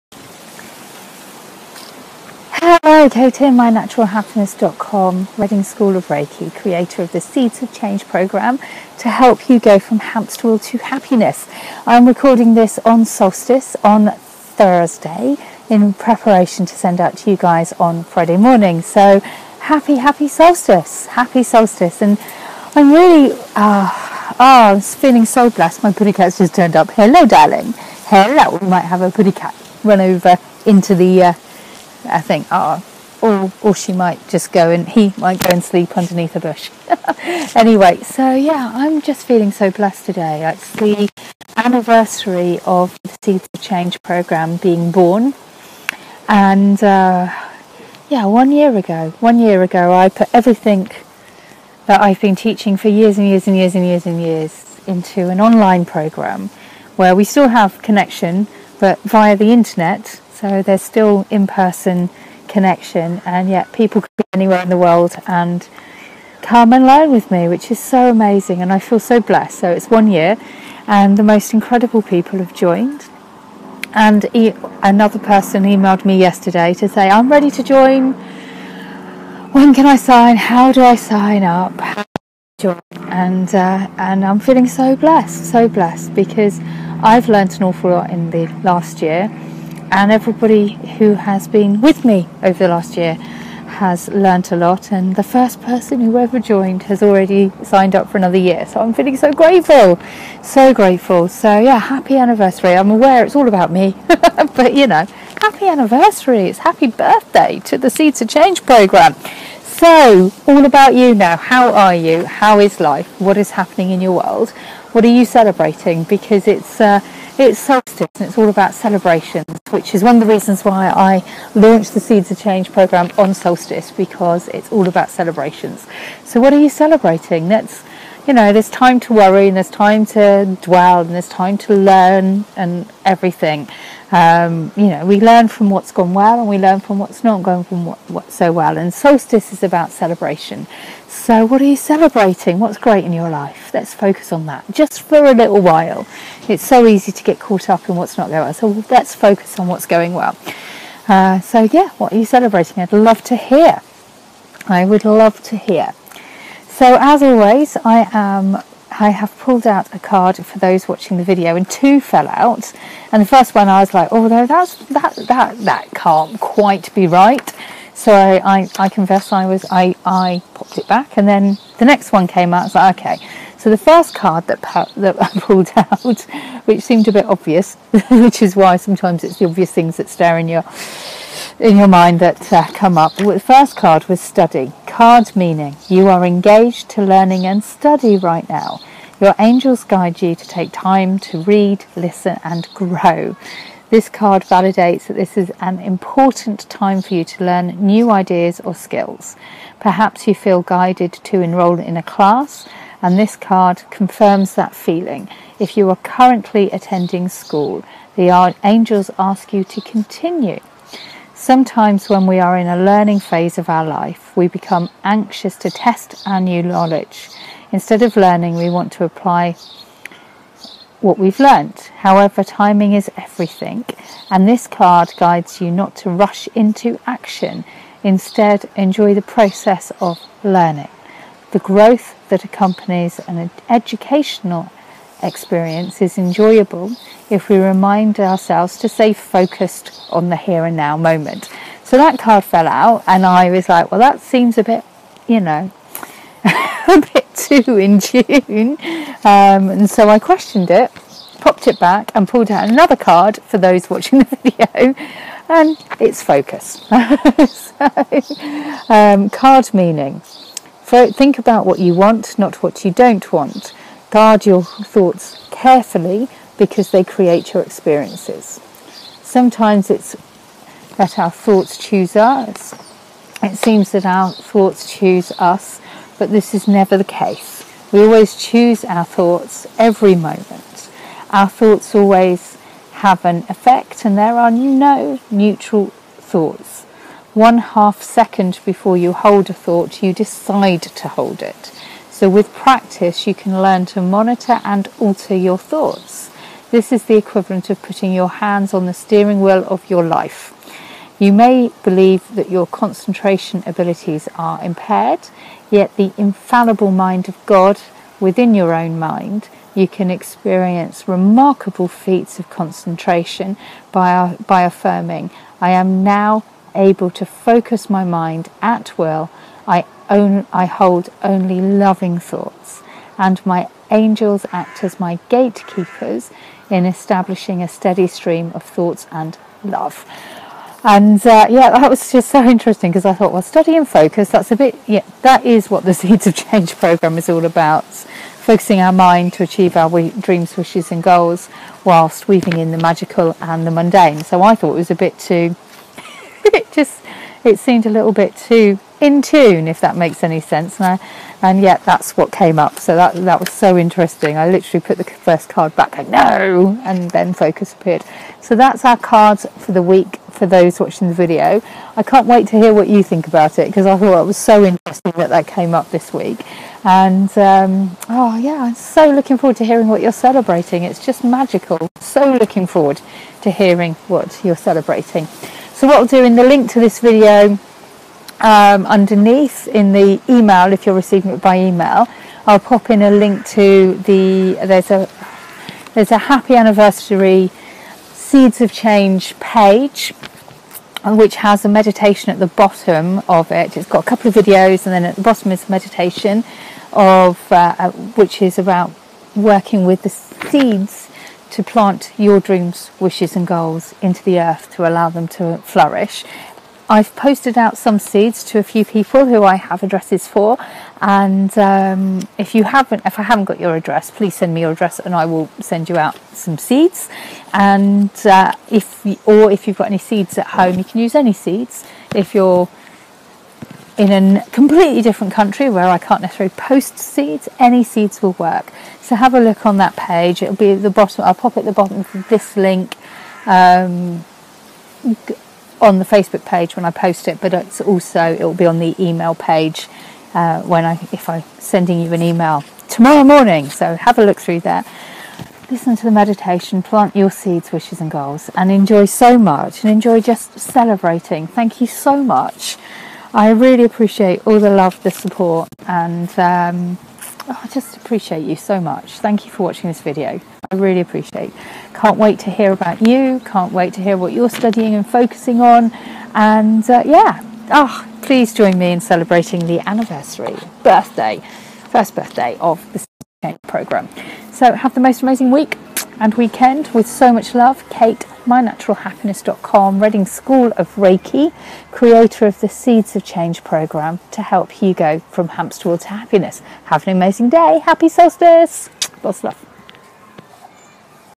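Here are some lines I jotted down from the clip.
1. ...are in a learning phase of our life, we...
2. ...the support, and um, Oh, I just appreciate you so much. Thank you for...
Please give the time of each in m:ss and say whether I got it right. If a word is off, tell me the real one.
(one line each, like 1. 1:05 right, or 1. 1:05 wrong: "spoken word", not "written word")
1. 3:32 right
2. 7:35 right.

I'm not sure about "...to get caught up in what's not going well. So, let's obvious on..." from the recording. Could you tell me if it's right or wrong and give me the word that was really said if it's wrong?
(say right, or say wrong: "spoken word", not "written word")
wrong: "focus", not "obvious".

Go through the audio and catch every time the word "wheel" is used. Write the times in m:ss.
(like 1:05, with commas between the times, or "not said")
0:10, 4:59, 8:05.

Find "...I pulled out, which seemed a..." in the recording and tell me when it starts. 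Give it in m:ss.
2:55.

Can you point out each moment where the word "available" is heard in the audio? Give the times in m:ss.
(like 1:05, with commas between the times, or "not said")
not said.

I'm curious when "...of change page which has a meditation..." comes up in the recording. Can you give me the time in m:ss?
6:28.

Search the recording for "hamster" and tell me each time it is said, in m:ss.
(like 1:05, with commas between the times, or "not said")
0:09, 8:05.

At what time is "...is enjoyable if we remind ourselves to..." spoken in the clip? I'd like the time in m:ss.
3:56.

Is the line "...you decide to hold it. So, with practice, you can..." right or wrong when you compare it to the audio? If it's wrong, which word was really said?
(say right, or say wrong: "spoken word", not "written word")
right.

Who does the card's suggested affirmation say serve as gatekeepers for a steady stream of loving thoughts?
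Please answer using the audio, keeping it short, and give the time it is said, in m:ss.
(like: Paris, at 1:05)
My angels, at 5:23.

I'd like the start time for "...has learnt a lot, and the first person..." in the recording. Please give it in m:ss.
1:33.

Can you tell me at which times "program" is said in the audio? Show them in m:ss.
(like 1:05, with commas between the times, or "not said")
0:08, 0:44, 0:55, 1:48, 2:02, 5:36, 7:53, 8:03.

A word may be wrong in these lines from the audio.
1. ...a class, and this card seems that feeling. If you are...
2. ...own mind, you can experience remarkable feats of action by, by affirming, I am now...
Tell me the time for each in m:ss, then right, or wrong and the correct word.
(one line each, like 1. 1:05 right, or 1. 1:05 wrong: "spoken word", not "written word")
1. 3:21 wrong: "confirms", not "seems"
2. 5:08 wrong: "concentration", not "action".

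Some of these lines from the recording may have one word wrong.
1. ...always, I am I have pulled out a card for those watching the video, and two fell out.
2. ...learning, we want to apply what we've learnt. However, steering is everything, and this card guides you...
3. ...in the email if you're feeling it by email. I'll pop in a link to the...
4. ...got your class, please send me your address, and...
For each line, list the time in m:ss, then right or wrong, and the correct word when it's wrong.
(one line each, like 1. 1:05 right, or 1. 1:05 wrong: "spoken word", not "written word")
1. 2:37 right
2. 3:38 wrong: "timing", not "steering"
3. 6:19 wrong: "receiving", not "feeling"
4. 6:53 wrong: "address", not "class".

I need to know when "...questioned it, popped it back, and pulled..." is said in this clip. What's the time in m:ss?
4:10.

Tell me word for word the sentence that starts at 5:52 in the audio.
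So that, that was so interesting.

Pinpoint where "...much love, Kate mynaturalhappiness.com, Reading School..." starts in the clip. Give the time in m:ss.
7:57.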